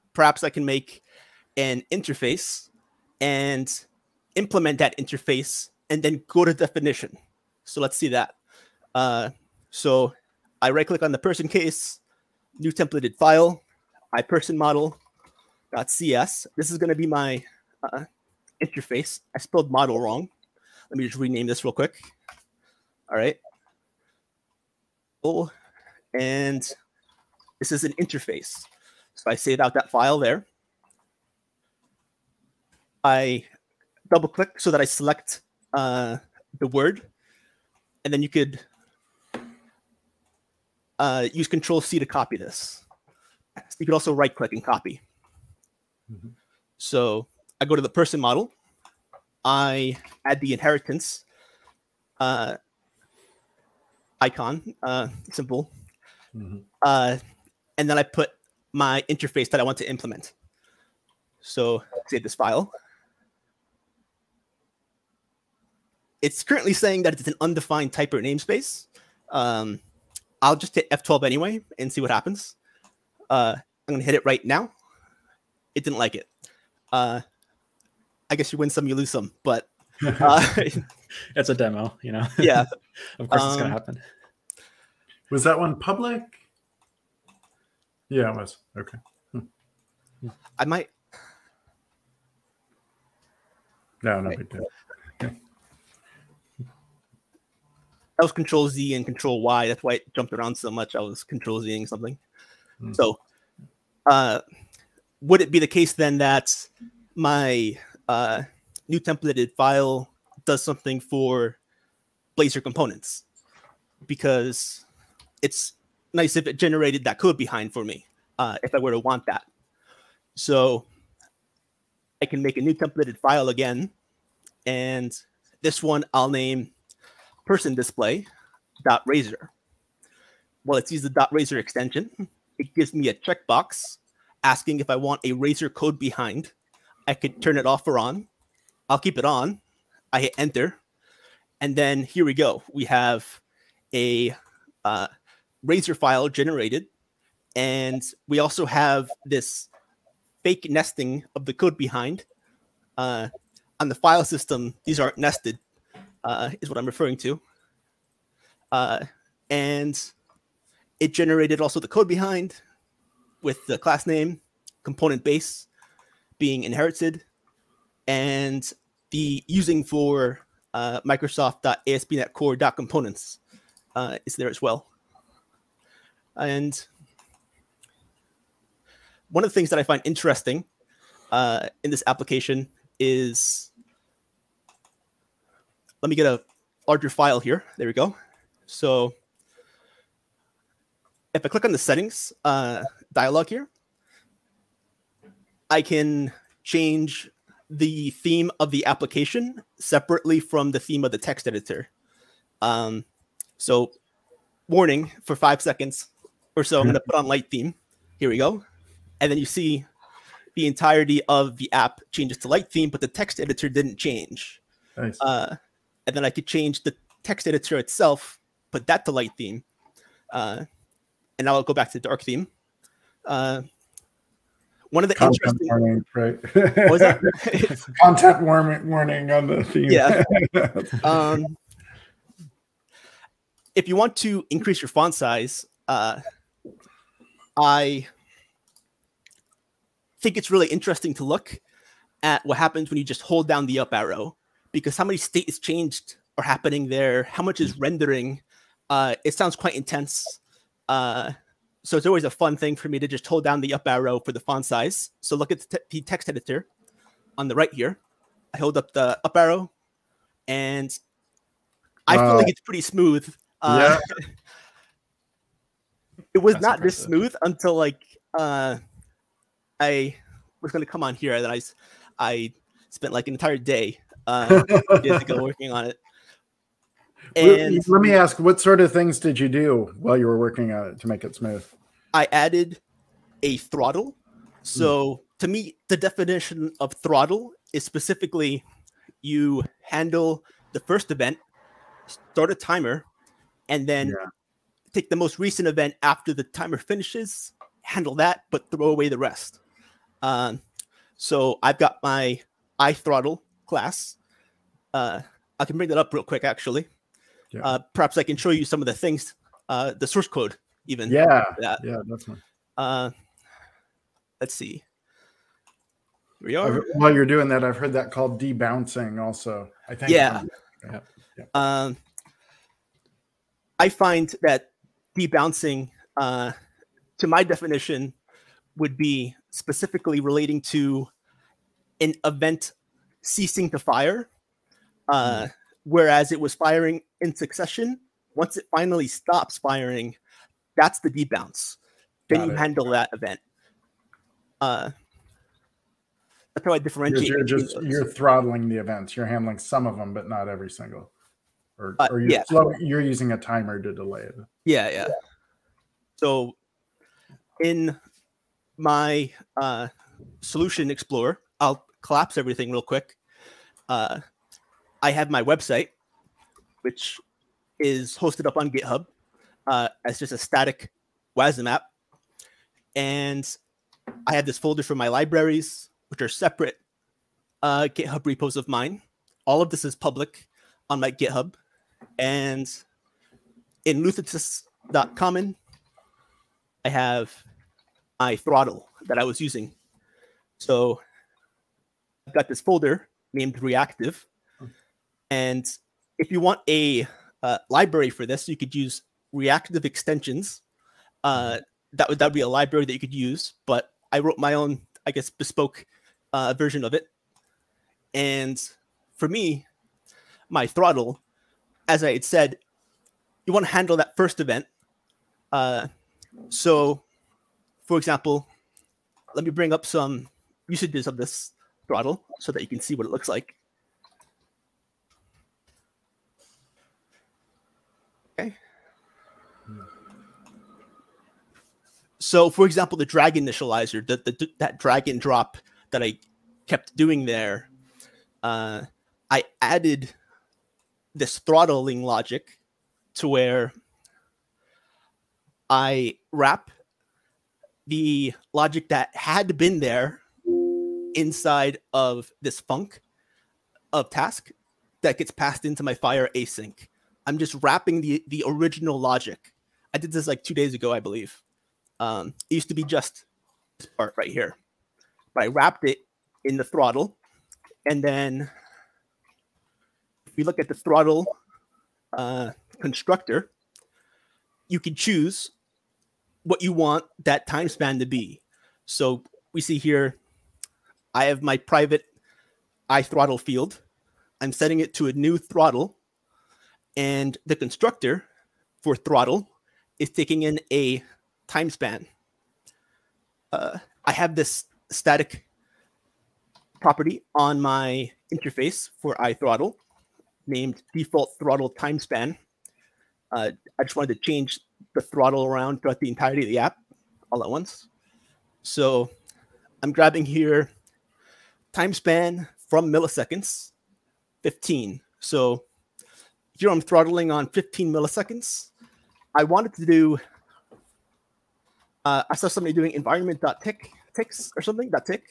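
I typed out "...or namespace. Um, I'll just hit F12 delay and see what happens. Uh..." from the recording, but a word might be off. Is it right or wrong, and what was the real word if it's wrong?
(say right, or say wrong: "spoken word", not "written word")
wrong: "anyway", not "delay".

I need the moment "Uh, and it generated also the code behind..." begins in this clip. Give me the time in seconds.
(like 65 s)
158 s.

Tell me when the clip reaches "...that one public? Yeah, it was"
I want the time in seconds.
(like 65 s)
85 s.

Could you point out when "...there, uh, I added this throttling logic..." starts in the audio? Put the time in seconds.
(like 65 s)
437 s.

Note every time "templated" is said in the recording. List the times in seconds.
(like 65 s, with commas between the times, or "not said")
12 s, 108 s, 122 s.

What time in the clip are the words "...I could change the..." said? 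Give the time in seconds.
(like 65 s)
216 s.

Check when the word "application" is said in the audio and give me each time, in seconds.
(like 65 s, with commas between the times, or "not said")
182 s, 198 s.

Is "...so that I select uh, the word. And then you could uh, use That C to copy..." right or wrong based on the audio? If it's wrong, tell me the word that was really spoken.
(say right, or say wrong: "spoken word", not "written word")
wrong: "Control", not "That".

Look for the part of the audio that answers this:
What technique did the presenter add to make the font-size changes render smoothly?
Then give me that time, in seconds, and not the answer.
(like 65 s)
282 s.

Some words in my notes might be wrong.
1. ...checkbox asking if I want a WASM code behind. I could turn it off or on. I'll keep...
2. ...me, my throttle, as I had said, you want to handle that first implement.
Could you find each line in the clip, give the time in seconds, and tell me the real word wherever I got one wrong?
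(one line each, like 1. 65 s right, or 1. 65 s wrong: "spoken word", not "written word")
1. 133 s wrong: "Razor", not "WASM"
2. 409 s wrong: "event", not "implement".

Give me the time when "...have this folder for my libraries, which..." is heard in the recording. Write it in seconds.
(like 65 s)
374 s.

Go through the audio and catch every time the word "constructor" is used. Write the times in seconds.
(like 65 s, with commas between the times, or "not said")
472 s, 487 s.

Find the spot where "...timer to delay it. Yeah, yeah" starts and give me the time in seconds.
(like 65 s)
353 s.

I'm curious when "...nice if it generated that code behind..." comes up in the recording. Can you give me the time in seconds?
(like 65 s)
116 s.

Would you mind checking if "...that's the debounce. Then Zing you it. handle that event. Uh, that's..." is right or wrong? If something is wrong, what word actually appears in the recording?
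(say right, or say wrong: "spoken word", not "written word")
wrong: "Got", not "Zing".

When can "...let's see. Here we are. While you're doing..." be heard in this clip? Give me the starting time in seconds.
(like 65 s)
314 s.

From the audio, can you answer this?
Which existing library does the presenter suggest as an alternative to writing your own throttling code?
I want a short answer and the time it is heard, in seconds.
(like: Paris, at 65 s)
Reactive Extensions, at 399 s.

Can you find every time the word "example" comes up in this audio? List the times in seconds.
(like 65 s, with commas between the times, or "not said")
417 s, 432 s.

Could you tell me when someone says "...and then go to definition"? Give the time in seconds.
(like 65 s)
5 s.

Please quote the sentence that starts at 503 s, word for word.
Uh, I just wanted to change the throttle around throughout the entirety of the app all at once.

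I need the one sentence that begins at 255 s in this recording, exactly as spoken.
So look at the, te the text editor on the right here.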